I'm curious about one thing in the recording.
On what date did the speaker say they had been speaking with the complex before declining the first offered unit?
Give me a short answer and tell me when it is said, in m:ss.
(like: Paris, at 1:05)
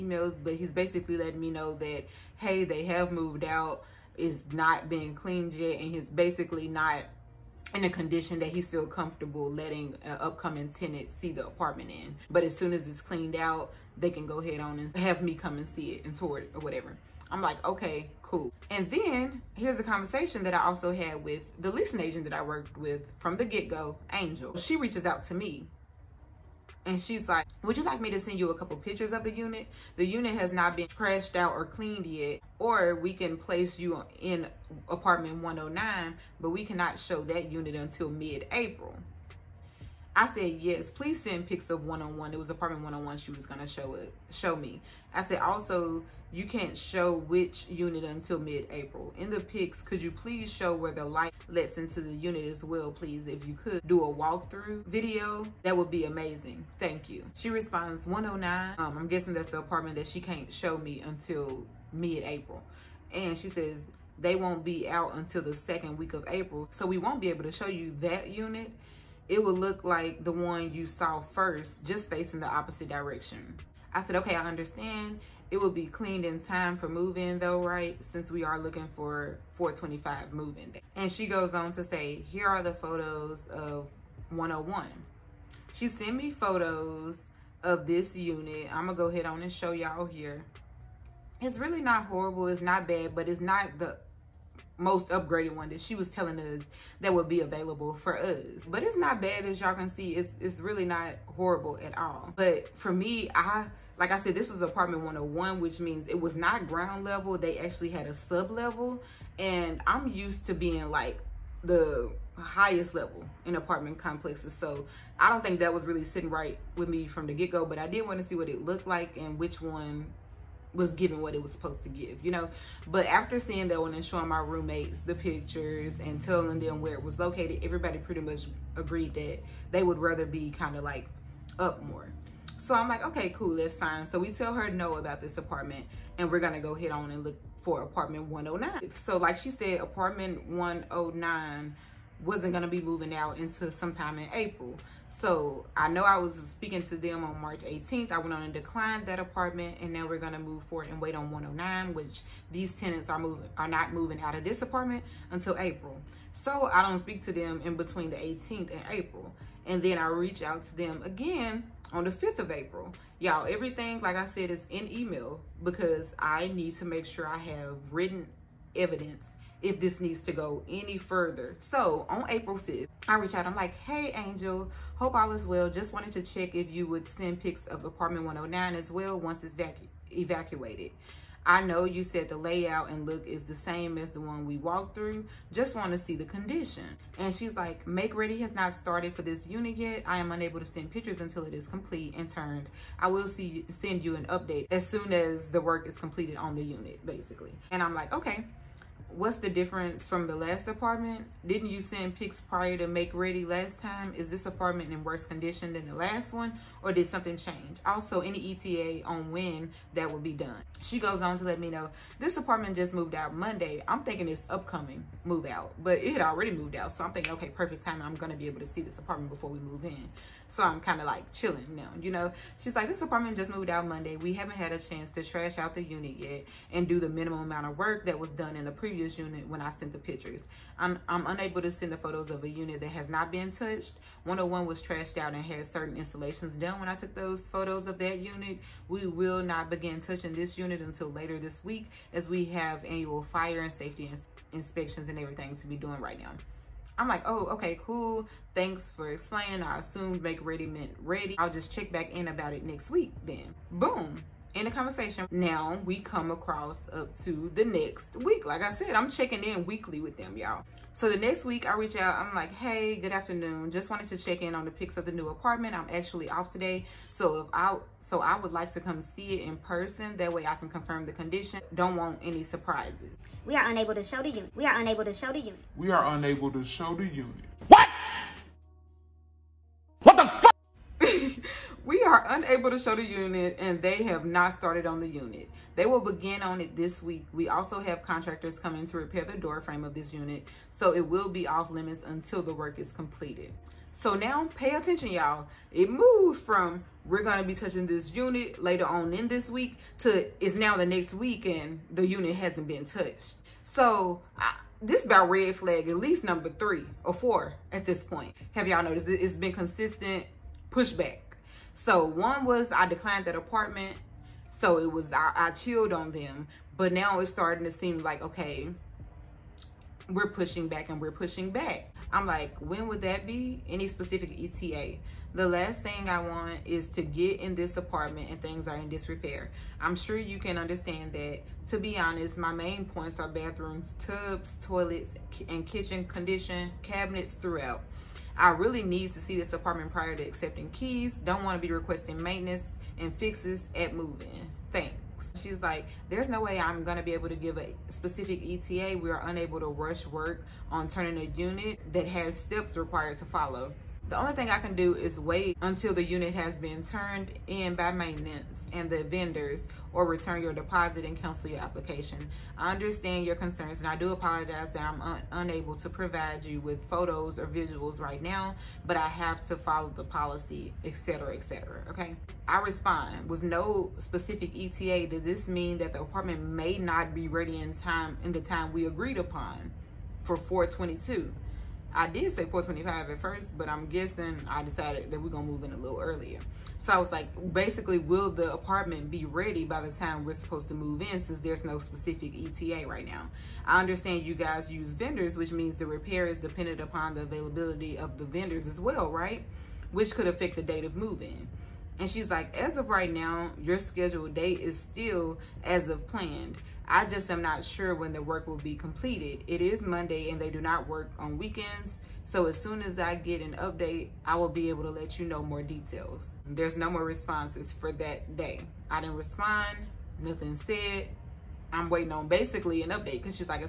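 March 18th, at 2:27.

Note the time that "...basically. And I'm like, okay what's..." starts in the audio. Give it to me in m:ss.
3:17.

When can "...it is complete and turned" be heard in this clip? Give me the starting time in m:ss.
3:11.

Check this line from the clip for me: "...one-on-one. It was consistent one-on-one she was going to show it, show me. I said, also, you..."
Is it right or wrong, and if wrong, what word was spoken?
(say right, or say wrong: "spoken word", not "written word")
wrong: "apartment", not "consistent".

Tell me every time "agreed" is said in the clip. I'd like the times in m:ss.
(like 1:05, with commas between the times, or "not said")
2:08, 6:18.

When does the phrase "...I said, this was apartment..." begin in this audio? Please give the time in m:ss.
1:44.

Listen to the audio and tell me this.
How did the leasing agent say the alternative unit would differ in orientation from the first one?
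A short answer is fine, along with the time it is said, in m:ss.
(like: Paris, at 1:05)
facing the opposite direction, at 1:12.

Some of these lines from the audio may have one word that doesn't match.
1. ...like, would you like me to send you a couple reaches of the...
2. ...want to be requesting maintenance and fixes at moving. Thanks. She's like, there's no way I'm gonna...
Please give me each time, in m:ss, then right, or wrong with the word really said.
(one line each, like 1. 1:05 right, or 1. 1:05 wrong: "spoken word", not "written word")
1. 0:27 wrong: "pictures", not "reaches"
2. 5:41 right.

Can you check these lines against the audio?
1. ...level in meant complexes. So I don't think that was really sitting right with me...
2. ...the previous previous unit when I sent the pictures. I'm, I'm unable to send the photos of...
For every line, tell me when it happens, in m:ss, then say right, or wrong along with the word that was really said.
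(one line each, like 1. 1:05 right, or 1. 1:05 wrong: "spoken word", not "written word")
1. 1:52 wrong: "apartment", not "meant"
2. 3:48 right.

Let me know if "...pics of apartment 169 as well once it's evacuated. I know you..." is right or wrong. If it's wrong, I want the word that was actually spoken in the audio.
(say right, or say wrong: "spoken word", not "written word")
wrong: "109", not "169".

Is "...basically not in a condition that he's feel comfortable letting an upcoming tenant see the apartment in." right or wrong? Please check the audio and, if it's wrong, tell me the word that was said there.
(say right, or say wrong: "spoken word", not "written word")
right.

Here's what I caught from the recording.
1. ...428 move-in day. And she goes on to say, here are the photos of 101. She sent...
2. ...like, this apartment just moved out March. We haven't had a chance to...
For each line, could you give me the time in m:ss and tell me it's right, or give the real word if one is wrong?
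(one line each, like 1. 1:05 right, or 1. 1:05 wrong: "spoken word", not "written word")
1. 1:19 wrong: "425", not "428"
2. 3:42 wrong: "Monday", not "March".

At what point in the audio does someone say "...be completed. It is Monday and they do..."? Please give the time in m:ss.
6:48.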